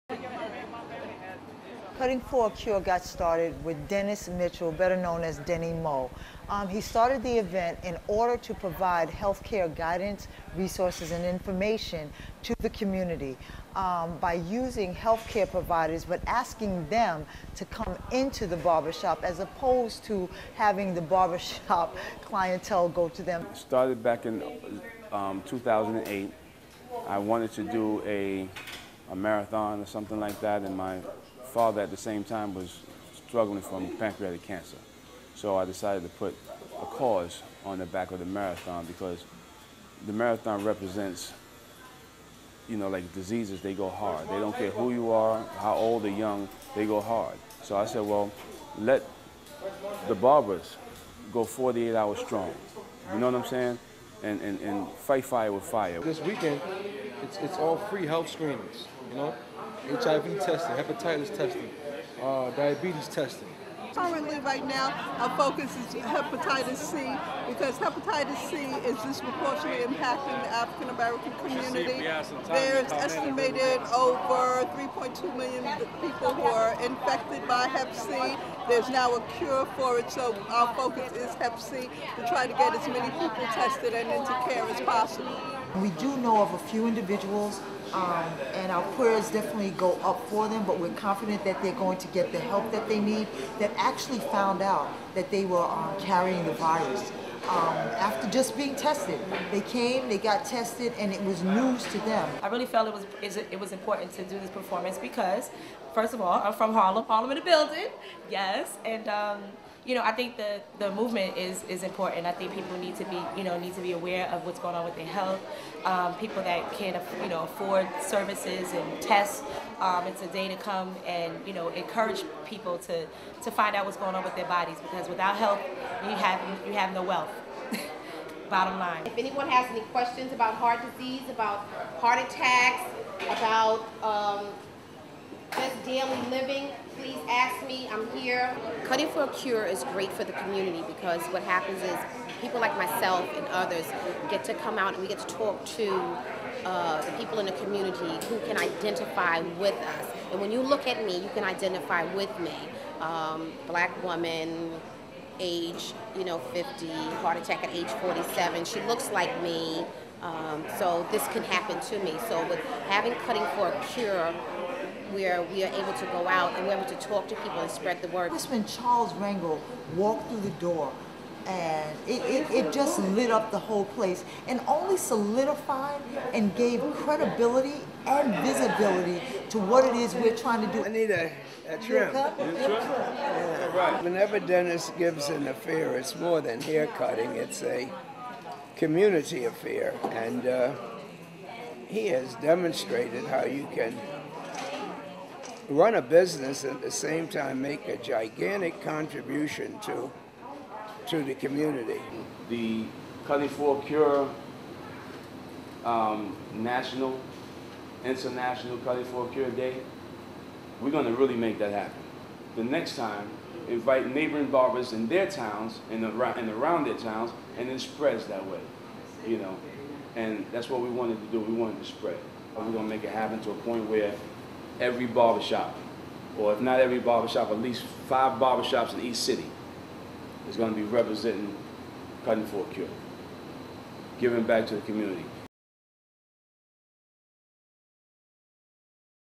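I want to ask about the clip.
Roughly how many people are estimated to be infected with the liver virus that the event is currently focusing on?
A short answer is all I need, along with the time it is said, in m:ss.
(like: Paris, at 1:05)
3.2 million, at 1:14.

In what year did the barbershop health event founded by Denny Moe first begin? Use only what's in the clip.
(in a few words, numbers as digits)
2008.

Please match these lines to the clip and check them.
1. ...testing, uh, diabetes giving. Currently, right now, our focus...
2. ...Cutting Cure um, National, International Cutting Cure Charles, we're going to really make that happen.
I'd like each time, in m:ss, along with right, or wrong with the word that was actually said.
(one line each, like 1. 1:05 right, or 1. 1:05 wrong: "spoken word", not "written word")
1. 1:01 wrong: "testing", not "giving"
2. 3:23 wrong: "Day", not "Charles".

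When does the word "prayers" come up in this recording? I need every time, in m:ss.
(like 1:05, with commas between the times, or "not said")
1:28.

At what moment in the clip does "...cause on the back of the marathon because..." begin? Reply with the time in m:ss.
0:36.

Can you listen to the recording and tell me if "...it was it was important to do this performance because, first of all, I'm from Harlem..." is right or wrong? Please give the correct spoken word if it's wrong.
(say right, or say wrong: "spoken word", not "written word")
right.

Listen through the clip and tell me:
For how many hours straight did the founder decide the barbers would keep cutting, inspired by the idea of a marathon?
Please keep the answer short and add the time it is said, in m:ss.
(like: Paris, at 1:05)
48, at 0:51.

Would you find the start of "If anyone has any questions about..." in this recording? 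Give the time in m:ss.
2:09.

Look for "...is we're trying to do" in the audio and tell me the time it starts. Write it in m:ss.
2:59.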